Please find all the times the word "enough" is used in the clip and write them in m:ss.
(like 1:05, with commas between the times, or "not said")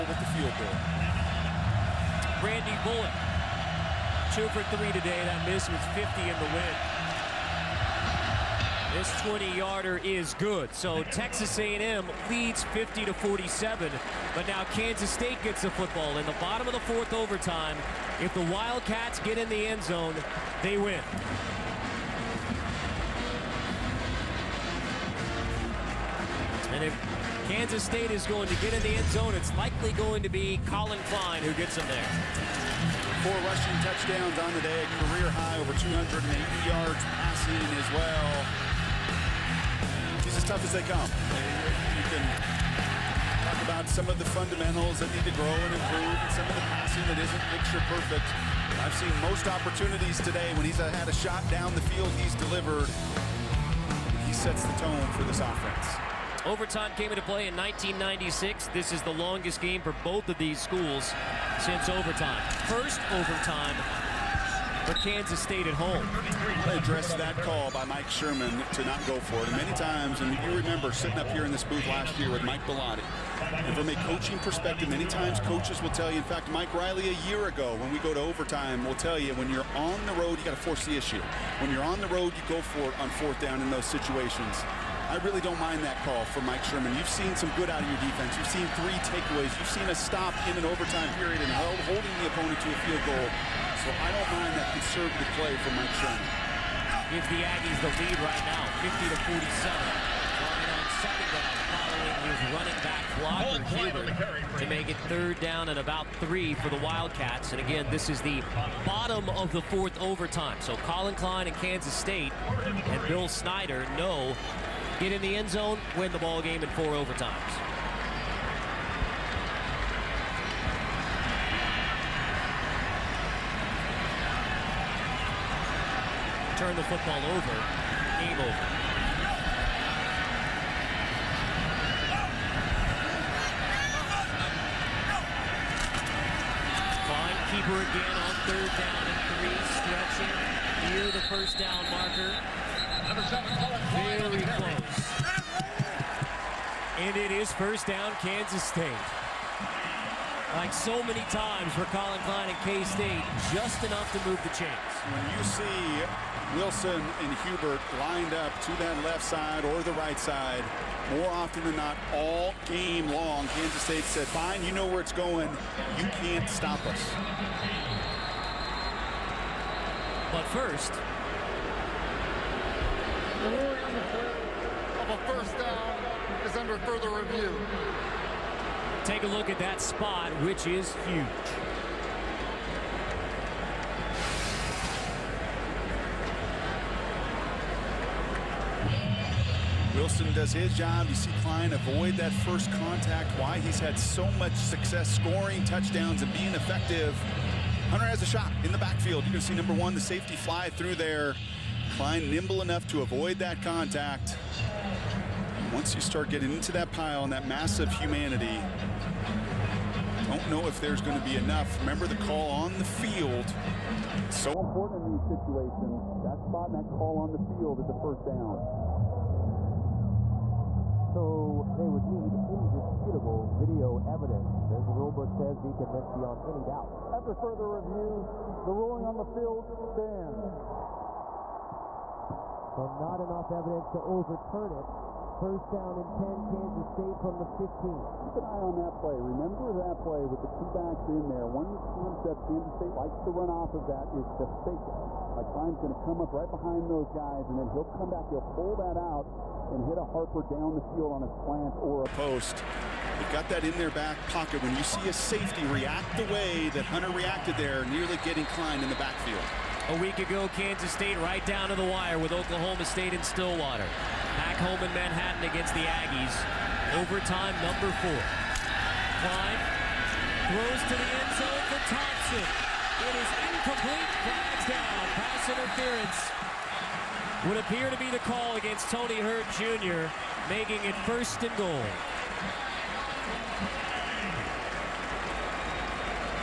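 2:33, 3:22, 3:31, 3:53.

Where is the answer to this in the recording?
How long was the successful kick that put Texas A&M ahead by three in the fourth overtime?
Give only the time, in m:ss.
0:09.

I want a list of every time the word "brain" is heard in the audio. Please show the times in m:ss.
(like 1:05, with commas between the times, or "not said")
not said.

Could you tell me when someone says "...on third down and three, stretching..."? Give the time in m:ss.
2:18.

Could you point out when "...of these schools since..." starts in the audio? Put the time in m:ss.
1:00.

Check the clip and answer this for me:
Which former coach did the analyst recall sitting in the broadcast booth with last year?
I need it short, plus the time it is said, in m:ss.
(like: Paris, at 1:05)
Mike Bellotti, at 1:12.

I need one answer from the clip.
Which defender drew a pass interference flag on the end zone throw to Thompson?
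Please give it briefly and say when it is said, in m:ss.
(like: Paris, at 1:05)
Tony Hurd Jr., at 4:38.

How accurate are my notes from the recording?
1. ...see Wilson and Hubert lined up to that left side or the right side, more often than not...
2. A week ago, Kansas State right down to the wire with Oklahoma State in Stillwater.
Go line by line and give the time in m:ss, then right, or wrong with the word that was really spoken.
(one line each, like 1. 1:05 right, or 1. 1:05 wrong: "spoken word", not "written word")
1. 2:35 right
2. 4:19 right.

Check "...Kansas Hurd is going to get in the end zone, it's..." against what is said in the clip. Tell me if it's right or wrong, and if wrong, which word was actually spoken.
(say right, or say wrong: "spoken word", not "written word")
wrong: "State", not "Hurd".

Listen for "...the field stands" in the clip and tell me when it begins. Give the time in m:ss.
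3:49.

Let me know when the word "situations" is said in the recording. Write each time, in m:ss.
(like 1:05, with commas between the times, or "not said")
1:23, 3:35.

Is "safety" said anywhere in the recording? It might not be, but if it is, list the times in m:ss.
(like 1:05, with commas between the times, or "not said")
3:20, 4:15.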